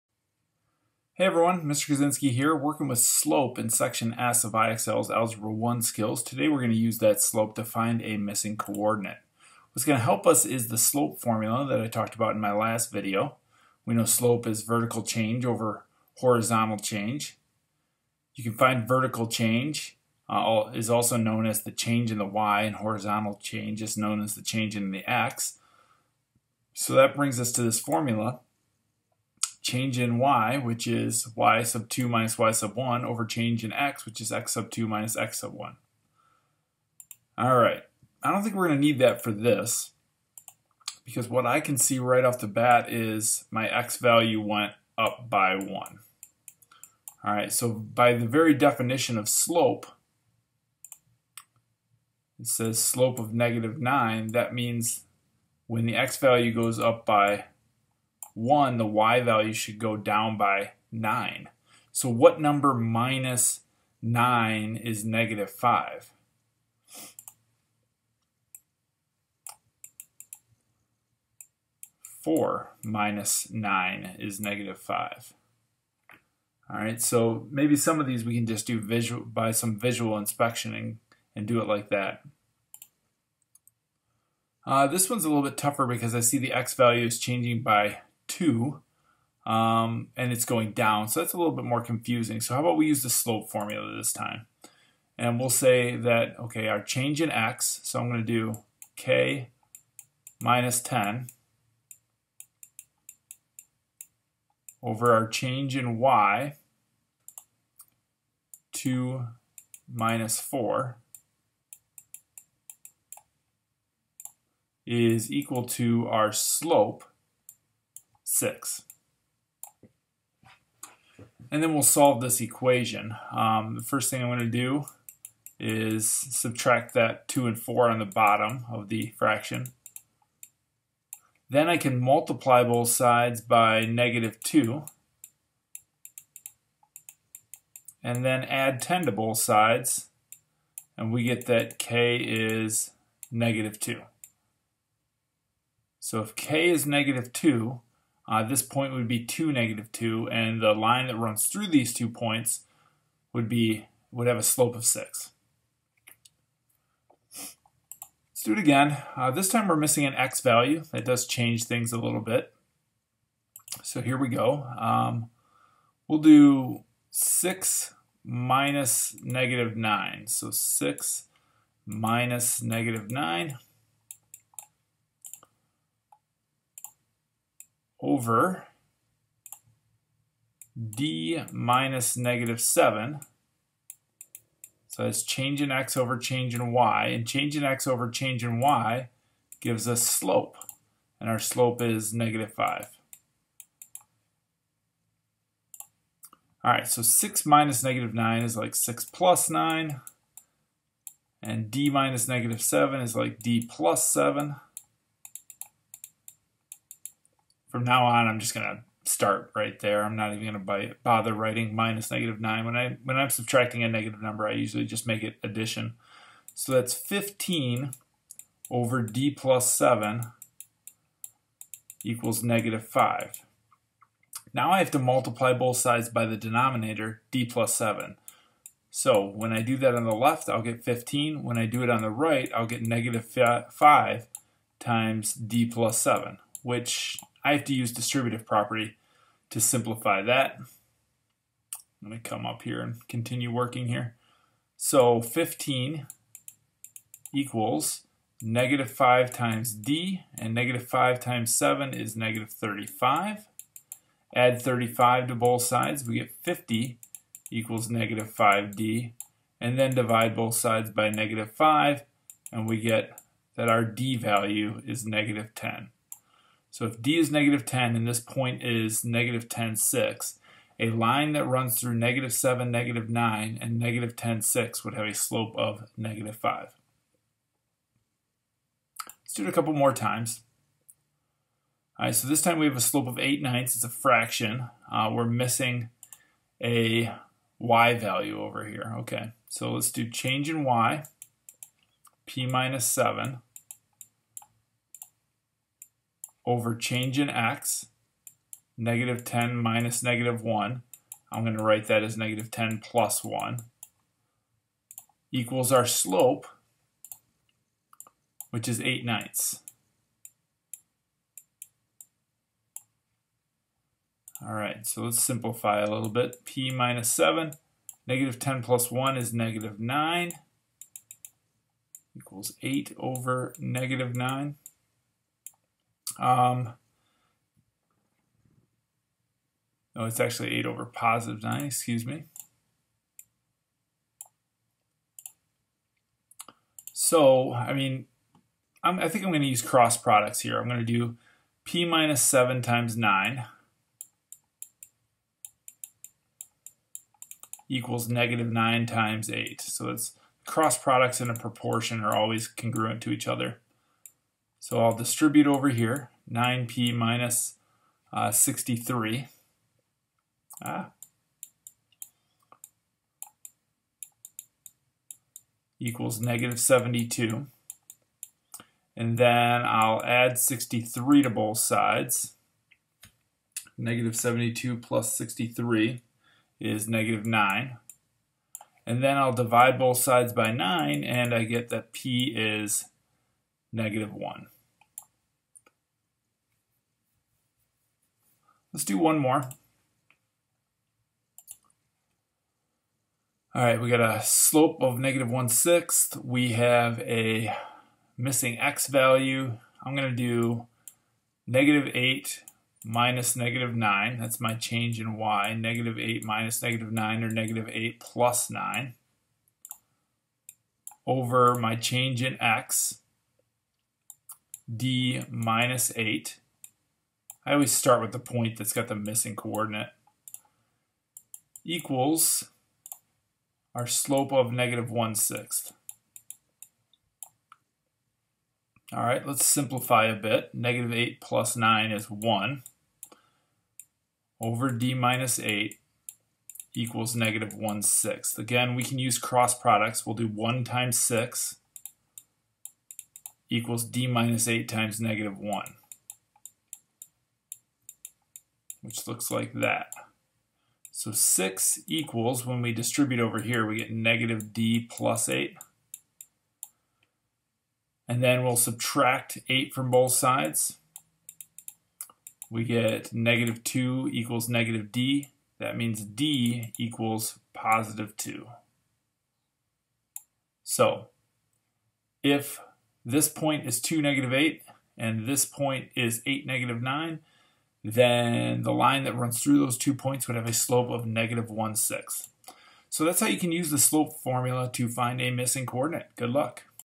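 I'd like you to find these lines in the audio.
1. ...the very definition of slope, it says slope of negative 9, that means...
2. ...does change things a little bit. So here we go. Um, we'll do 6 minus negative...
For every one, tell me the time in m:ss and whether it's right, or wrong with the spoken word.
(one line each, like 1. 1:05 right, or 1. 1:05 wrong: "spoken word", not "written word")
1. 0:48 right
2. 2:41 right.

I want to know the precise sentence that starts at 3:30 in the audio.
I'm not even gonna bother writing minus negative nine.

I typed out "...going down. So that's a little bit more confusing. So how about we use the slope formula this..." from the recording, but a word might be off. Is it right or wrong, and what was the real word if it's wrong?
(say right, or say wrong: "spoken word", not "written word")
right.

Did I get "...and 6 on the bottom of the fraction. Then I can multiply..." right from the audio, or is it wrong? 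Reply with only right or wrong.
wrong.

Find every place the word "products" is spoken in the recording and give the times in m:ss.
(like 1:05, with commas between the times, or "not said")
5:39, 5:50, 7:19.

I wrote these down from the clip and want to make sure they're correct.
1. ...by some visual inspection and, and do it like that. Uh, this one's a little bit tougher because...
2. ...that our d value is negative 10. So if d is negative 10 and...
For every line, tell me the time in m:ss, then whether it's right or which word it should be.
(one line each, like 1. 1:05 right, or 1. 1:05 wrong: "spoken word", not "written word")
1. 1:19 right
2. 4:23 right.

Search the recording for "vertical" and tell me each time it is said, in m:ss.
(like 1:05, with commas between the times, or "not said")
0:14, 0:18.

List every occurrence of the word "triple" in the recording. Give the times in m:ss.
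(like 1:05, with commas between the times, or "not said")
not said.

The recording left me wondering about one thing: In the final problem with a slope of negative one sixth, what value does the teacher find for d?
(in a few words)
2.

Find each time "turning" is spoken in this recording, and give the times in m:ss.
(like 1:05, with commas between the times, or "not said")
not said.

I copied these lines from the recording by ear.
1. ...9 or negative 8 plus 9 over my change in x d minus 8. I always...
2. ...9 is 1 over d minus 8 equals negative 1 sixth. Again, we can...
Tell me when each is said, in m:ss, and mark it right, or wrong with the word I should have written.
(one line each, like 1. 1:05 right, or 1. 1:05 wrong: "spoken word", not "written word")
1. 6:46 right
2. 7:11 right.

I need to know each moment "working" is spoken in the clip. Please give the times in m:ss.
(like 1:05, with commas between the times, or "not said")
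0:02, 4:03.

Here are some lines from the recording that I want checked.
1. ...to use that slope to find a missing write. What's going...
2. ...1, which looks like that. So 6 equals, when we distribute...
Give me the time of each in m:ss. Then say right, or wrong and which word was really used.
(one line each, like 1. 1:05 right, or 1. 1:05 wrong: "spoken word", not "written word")
1. 0:06 wrong: "coordinate", not "write"
2. 7:25 right.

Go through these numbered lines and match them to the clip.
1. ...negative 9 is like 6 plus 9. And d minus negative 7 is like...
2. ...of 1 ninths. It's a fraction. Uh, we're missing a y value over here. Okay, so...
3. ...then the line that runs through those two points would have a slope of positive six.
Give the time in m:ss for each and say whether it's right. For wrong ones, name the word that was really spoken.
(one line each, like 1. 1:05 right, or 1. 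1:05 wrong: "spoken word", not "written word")
1. 3:17 right
2. 4:43 wrong: "8", not "1"
3. 7:57 wrong: "negative", not "positive".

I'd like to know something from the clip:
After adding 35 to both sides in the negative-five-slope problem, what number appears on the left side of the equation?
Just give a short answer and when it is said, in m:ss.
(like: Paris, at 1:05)
50, at 4:16.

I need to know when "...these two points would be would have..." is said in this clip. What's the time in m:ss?
2:31.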